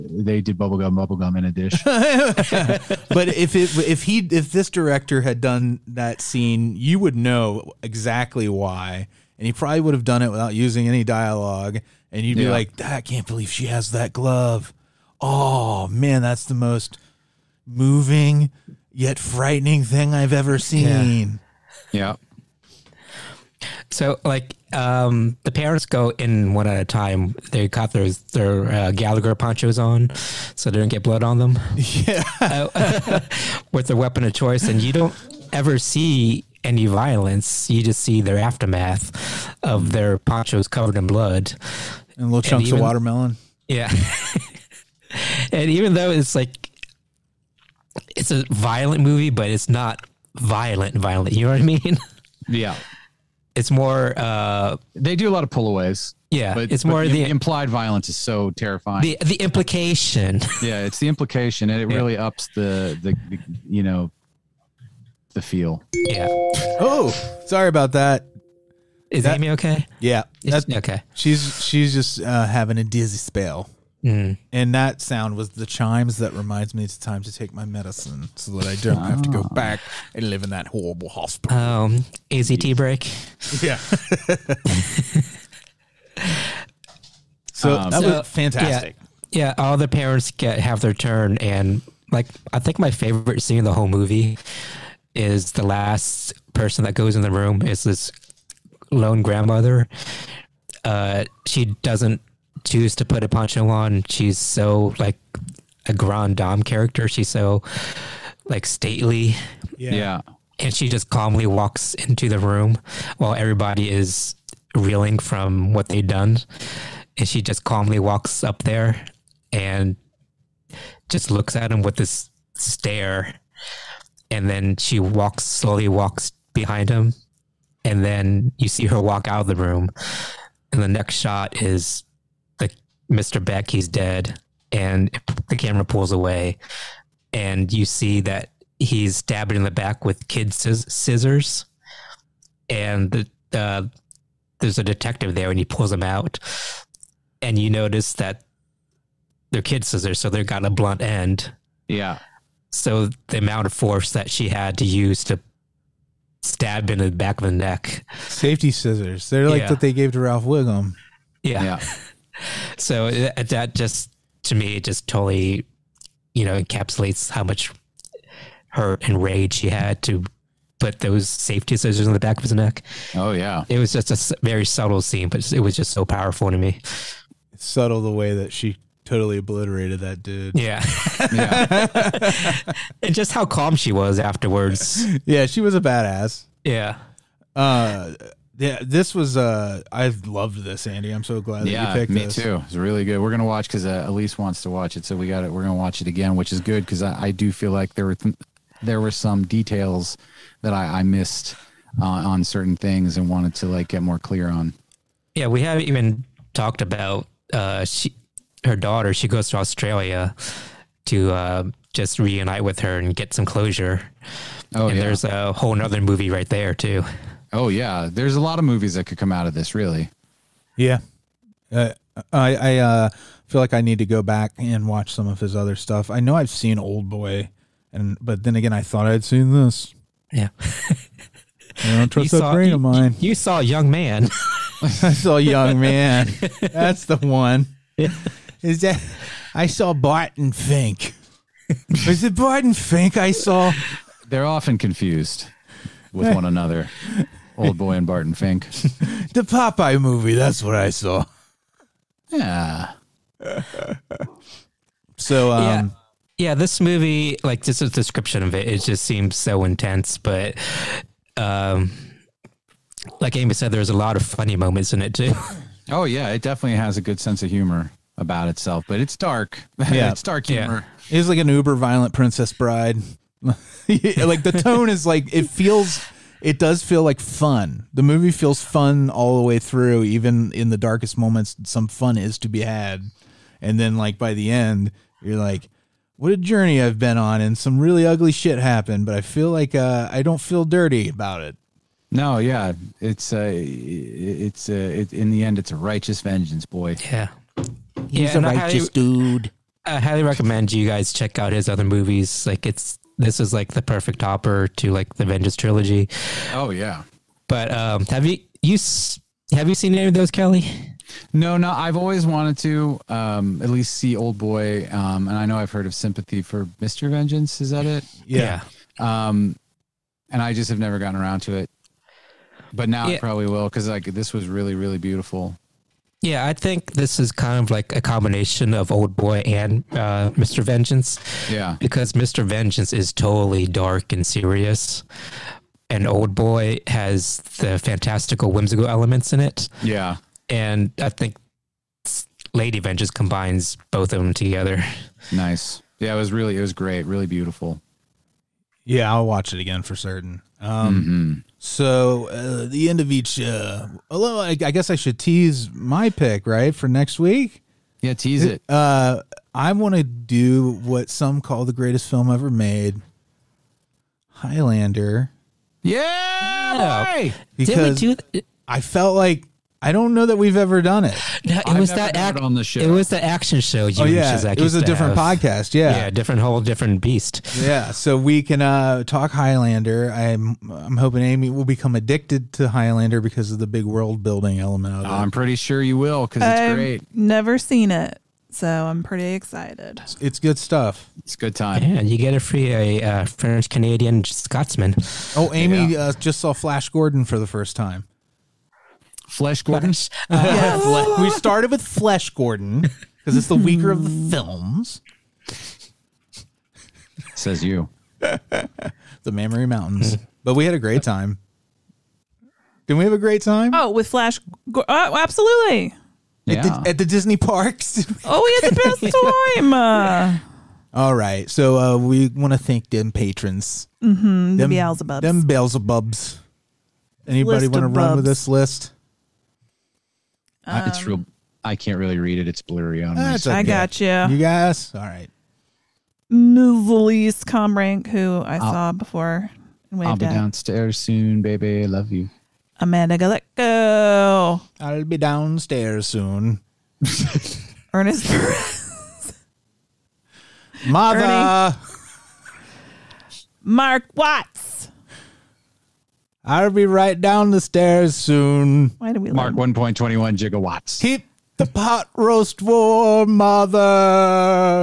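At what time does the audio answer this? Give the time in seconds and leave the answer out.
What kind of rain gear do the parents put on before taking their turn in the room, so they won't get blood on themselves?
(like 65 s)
28 s.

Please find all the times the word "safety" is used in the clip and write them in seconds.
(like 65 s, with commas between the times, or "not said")
158 s, 171 s.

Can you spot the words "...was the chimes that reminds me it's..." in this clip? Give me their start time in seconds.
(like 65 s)
75 s.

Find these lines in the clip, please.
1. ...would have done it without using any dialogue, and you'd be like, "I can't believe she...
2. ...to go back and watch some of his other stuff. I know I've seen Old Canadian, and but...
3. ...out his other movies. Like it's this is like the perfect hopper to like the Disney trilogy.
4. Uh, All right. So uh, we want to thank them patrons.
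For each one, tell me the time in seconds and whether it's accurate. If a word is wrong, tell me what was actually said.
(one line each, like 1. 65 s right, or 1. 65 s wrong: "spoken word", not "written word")
1. 9 s right
2. 223 s wrong: "Boy", not "Canadian"
3. 301 s wrong: "Vengeance", not "Disney"
4. 419 s right.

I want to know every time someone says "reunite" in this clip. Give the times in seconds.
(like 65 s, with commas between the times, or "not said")
212 s.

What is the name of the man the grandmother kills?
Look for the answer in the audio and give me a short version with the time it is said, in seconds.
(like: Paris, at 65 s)
Mr. Baek, at 133 s.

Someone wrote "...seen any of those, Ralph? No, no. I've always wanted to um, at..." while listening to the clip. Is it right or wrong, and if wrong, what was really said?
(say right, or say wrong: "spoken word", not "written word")
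wrong: "Kelley", not "Ralph".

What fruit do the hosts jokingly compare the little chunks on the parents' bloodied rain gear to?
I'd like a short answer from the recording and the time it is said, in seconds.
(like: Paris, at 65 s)
watermelon, at 42 s.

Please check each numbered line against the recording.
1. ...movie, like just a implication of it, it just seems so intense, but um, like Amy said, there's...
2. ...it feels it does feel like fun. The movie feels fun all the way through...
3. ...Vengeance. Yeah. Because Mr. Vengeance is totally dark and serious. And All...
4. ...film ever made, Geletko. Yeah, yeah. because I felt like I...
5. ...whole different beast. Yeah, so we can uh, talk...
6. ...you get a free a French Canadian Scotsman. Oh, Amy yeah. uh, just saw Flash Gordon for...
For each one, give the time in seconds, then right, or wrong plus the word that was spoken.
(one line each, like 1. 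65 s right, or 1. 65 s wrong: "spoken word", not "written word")
1. 256 s wrong: "description", not "implication"
2. 275 s right
3. 330 s wrong: "Old", not "All"
4. 362 s wrong: "Highlander", not "Geletko"
5. 376 s right
6. 392 s right.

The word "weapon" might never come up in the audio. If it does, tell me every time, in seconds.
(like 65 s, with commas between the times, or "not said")
33 s.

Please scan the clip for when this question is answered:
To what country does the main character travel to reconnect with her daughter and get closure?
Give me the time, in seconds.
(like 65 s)
209 s.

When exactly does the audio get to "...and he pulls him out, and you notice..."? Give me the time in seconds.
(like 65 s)
145 s.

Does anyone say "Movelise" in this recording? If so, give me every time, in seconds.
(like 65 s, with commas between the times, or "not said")
436 s.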